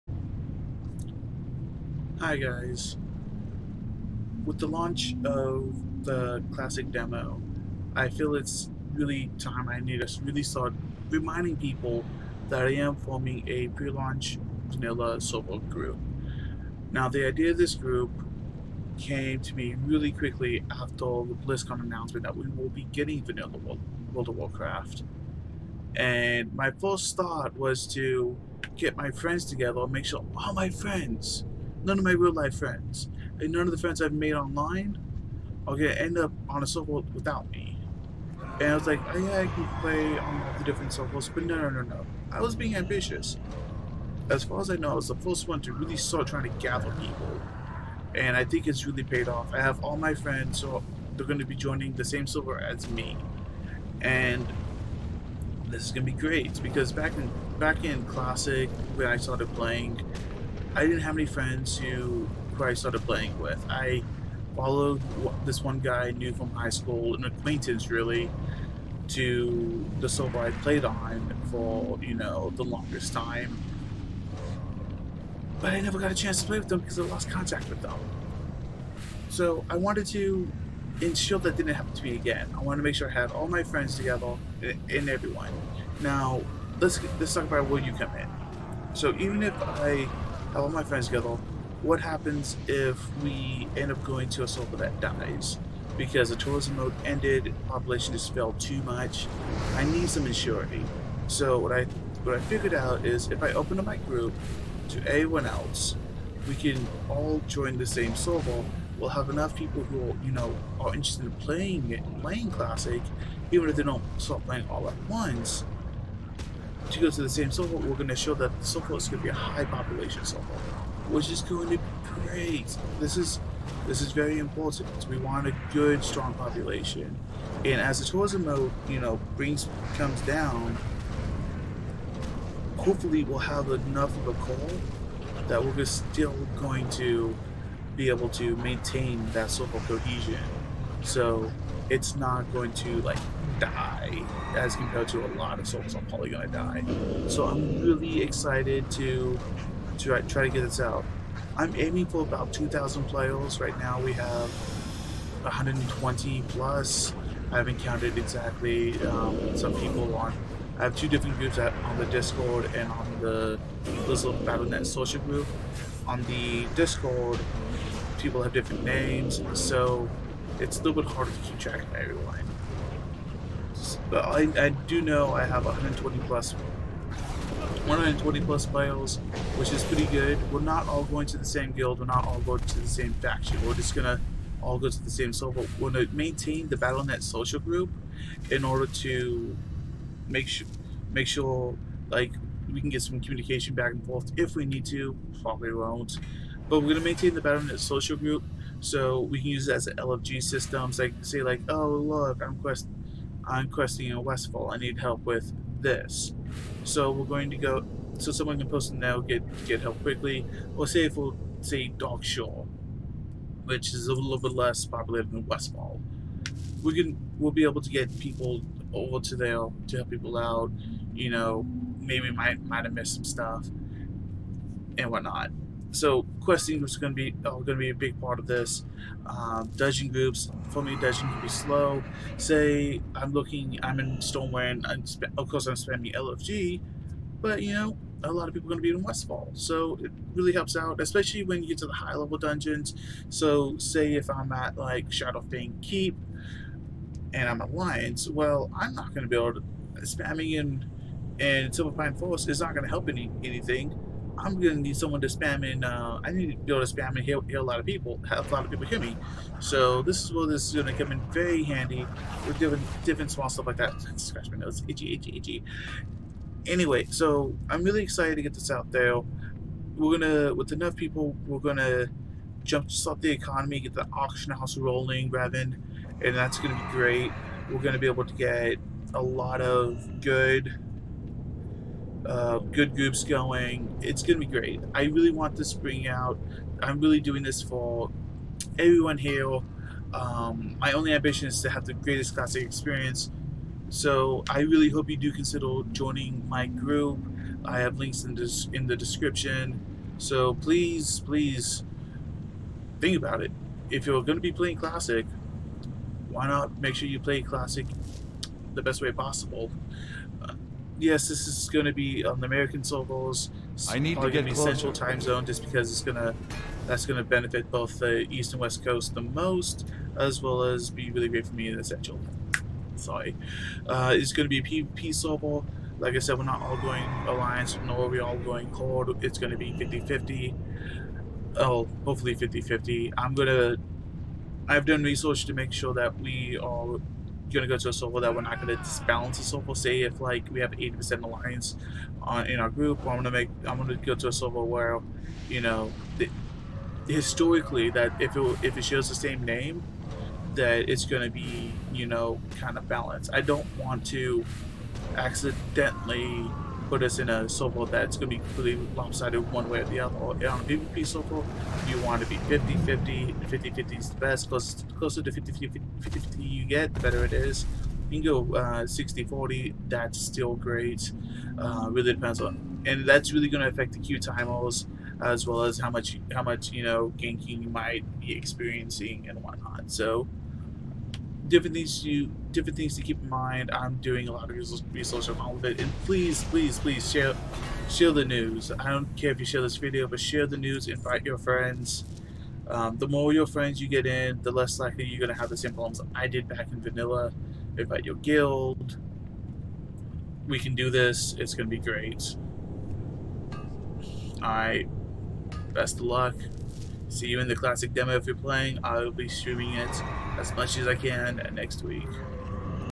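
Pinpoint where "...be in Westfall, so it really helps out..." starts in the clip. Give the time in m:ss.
3:58.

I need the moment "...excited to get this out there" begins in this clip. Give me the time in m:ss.
4:28.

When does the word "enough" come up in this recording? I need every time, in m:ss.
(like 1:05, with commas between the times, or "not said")
1:49, 2:13, 4:30.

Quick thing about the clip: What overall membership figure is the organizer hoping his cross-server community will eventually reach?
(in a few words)
2,000.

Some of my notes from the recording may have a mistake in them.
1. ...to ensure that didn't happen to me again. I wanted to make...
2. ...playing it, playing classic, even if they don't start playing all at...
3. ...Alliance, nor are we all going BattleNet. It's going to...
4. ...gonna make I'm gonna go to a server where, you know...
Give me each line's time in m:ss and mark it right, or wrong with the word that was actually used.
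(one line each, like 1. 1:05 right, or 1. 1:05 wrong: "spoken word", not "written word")
1. 1:20 right
2. 1:51 right
3. 5:27 wrong: "Horde", not "BattleNet"
4. 5:43 right.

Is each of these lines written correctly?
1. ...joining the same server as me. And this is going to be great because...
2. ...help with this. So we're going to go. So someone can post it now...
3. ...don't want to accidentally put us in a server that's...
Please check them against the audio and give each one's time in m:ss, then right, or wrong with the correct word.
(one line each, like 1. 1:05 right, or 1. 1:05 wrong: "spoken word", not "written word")
1. 0:51 right
2. 3:24 right
3. 5:53 right.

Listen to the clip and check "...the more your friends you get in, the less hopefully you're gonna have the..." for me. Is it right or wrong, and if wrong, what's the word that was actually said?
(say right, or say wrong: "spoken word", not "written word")
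wrong: "likely", not "hopefully".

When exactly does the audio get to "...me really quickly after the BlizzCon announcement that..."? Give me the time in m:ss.
0:19.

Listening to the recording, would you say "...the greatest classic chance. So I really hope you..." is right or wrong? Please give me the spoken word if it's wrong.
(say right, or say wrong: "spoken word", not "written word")
wrong: "experience", not "chance".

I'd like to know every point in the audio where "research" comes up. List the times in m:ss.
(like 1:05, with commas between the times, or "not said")
5:35, 6:24.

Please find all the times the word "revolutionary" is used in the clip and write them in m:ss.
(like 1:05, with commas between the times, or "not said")
not said.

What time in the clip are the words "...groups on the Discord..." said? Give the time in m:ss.
2:41.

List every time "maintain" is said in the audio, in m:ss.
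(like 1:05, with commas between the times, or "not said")
2:18, 3:06, 3:17.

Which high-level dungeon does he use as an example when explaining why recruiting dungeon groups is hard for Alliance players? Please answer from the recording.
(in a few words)
Shadowfang Keep.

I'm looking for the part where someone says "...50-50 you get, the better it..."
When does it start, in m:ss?
6:05.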